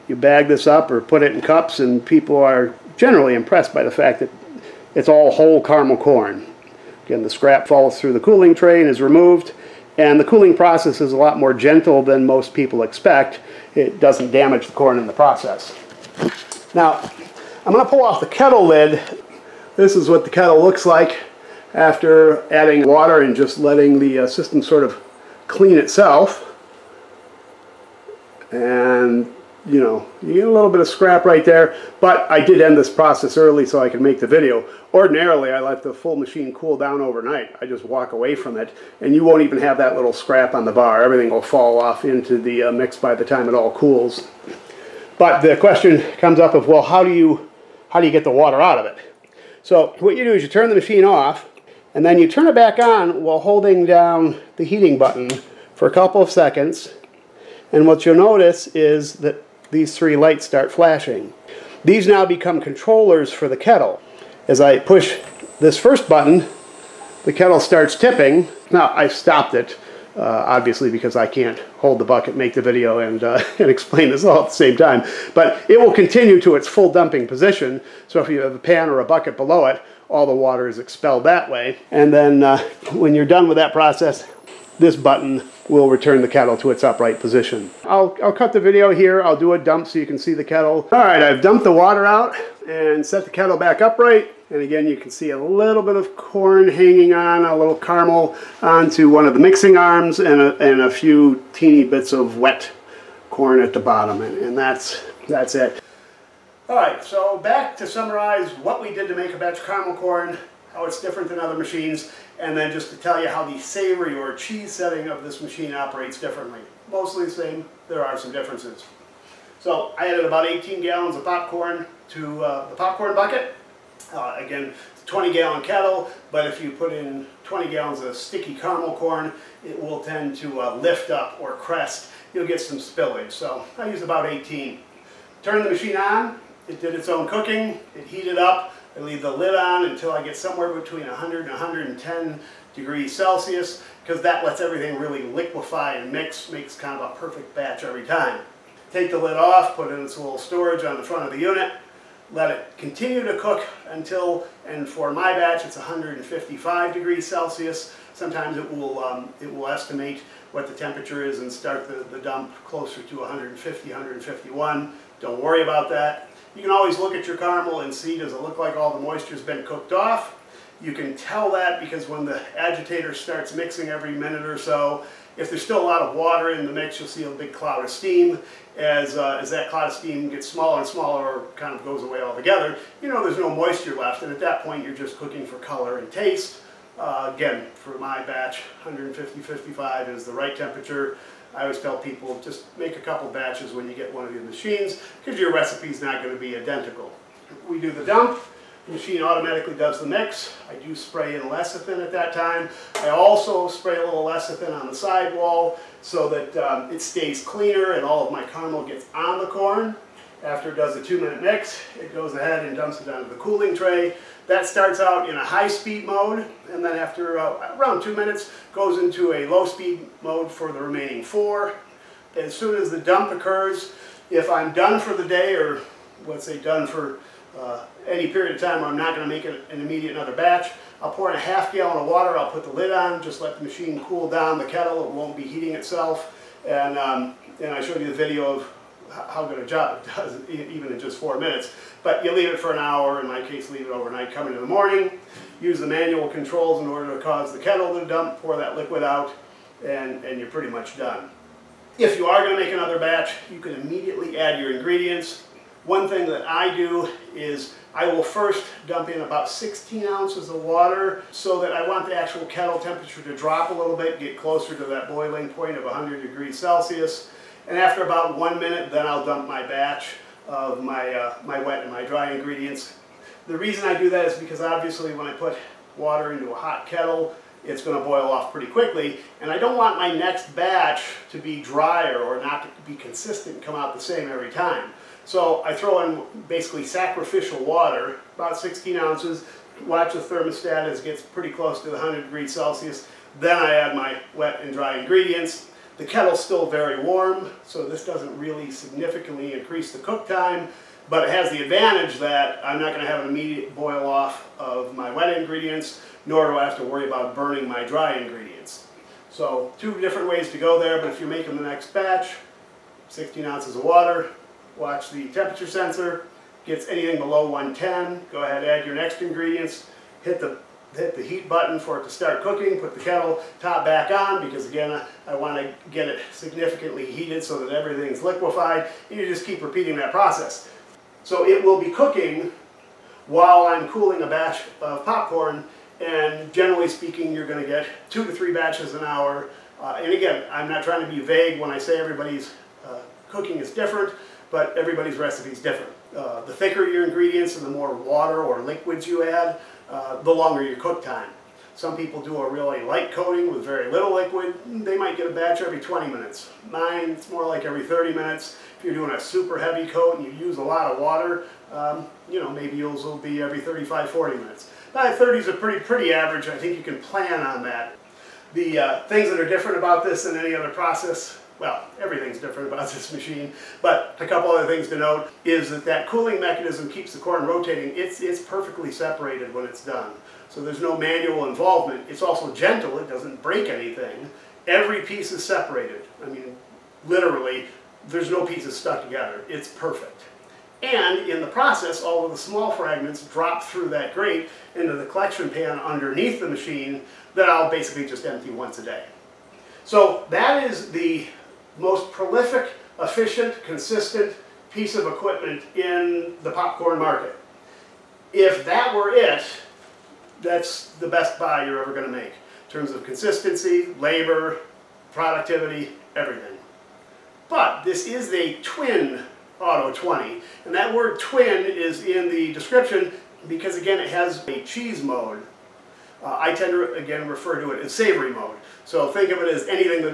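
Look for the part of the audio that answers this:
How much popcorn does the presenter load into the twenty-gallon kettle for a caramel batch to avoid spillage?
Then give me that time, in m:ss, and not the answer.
2:00.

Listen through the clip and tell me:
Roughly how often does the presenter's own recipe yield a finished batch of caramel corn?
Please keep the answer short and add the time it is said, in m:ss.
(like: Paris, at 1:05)
every 30 minutes, at 5:57.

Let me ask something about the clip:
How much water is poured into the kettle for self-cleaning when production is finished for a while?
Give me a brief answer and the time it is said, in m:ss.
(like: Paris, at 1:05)
half gallon, at 3:51.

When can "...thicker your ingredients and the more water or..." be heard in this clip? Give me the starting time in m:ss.
5:46.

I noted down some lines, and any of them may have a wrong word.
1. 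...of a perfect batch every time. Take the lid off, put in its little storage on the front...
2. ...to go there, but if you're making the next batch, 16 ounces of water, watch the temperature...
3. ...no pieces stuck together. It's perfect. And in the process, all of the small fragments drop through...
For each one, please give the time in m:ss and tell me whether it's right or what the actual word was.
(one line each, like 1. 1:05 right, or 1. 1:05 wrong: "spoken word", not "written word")
1. 2:27 right
2. 5:10 right
3. 6:28 right.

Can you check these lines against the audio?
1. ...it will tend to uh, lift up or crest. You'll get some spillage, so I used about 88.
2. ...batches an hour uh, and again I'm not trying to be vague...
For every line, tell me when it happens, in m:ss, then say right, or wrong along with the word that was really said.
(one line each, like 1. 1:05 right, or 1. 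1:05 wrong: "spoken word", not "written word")
1. 2:09 wrong: "18", not "88"
2. 5:38 right.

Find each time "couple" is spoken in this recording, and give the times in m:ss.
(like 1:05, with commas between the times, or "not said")
0:55, 3:13, 6:14.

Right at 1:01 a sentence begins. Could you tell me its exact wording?
These now become controllers for the kettle.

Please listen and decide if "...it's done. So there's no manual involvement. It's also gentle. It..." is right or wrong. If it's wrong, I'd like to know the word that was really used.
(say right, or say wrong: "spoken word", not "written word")
right.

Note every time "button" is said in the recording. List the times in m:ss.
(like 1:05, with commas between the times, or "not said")
0:54, 1:06, 1:24, 5:21.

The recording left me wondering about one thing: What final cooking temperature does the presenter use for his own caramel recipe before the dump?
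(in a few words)
155 degrees Celsius.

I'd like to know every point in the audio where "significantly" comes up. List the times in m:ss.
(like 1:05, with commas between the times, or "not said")
4:58, 5:26.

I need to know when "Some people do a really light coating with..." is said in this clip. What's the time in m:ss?
5:51.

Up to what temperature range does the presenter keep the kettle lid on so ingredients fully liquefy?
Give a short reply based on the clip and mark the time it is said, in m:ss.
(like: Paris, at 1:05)
100 to 110 degrees Celsius, at 2:20.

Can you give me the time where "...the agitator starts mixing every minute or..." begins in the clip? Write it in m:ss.
2:52.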